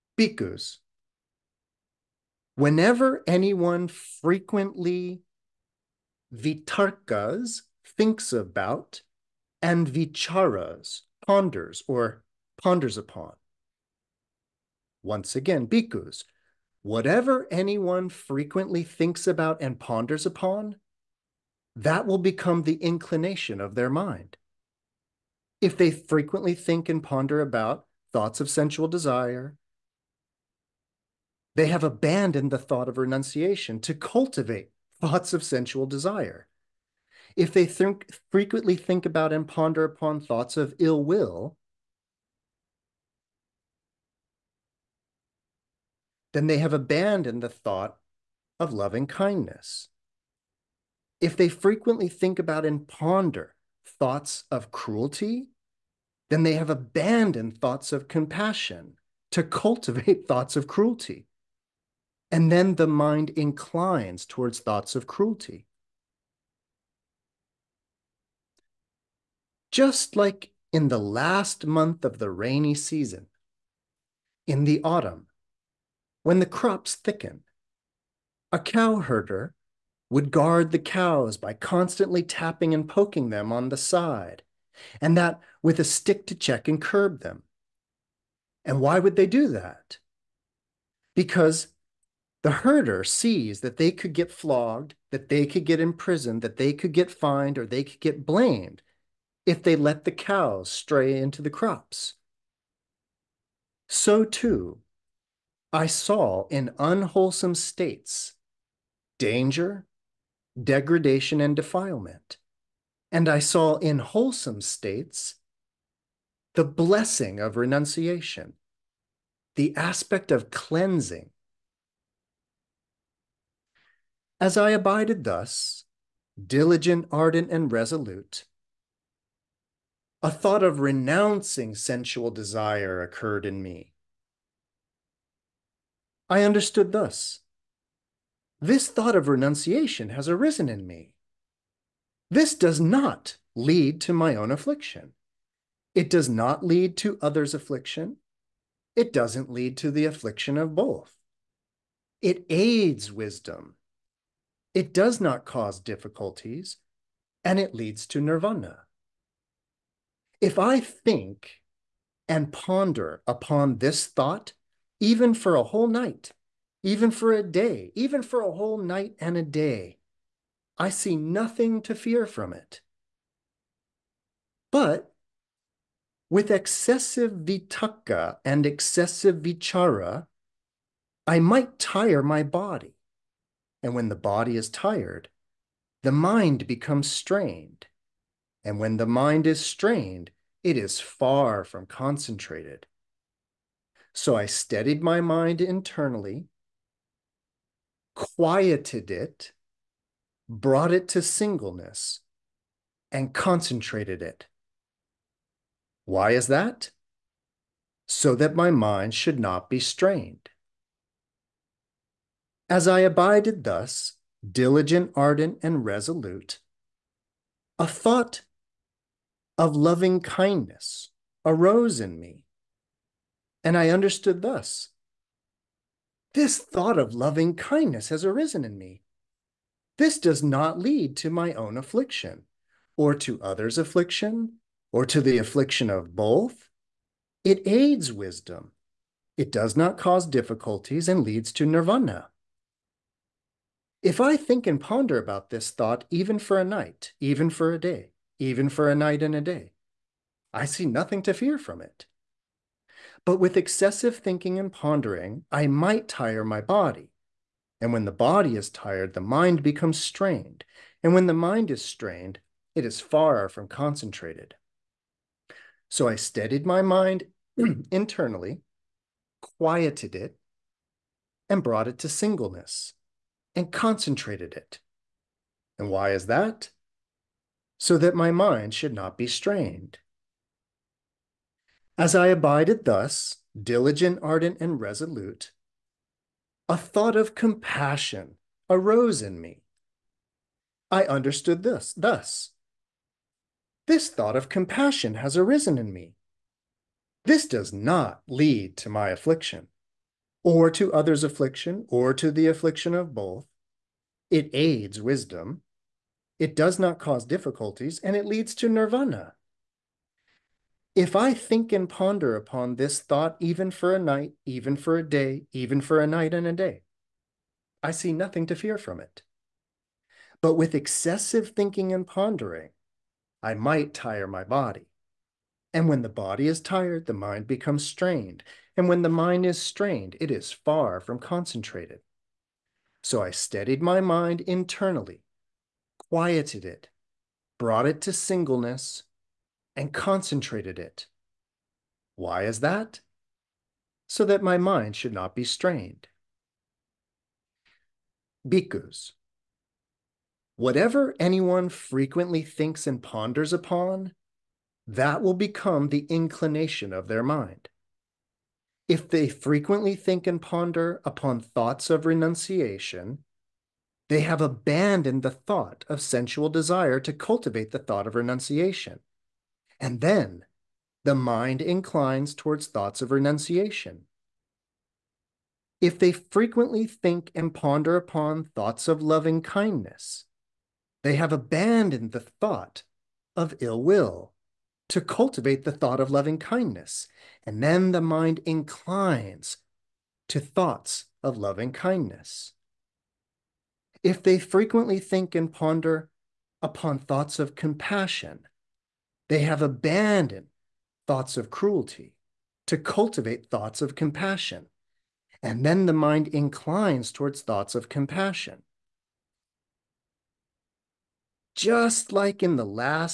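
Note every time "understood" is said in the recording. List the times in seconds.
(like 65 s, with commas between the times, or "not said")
136 s, 223 s, 291 s.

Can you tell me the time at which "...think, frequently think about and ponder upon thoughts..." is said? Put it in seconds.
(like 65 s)
37 s.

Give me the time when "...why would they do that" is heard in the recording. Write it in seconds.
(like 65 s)
88 s.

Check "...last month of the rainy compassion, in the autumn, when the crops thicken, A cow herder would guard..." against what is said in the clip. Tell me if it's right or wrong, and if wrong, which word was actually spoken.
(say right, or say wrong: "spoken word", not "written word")
wrong: "season", not "compassion".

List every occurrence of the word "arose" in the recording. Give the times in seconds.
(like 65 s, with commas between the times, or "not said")
221 s, 288 s.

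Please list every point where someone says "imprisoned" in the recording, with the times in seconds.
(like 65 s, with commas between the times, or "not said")
95 s.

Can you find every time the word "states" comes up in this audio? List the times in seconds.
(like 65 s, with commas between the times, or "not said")
107 s, 114 s.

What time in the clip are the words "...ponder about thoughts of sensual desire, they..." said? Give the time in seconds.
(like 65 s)
27 s.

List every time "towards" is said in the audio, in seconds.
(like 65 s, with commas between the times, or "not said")
64 s, 372 s, 407 s.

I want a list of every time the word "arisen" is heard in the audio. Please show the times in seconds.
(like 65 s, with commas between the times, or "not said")
140 s, 228 s, 295 s.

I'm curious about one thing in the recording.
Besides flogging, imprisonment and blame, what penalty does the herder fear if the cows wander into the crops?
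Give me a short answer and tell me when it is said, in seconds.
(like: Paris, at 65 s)
Fined, at 97 s.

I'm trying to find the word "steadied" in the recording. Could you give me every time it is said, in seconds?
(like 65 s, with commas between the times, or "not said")
194 s, 266 s, 333 s.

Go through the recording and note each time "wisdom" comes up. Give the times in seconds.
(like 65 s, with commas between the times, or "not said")
153 s, 238 s, 305 s.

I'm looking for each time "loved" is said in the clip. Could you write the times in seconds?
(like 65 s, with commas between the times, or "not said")
not said.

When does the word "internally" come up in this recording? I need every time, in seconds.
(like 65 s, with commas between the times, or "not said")
195 s, 267 s, 334 s.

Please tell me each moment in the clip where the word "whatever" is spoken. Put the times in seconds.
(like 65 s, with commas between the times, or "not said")
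16 s, 350 s.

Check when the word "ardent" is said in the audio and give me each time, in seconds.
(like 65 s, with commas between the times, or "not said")
127 s, 215 s, 284 s.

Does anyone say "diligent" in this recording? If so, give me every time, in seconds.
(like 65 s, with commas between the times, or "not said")
126 s, 214 s, 283 s.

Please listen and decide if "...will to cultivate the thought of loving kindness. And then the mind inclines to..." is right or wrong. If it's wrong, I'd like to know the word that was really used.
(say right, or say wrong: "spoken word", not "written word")
right.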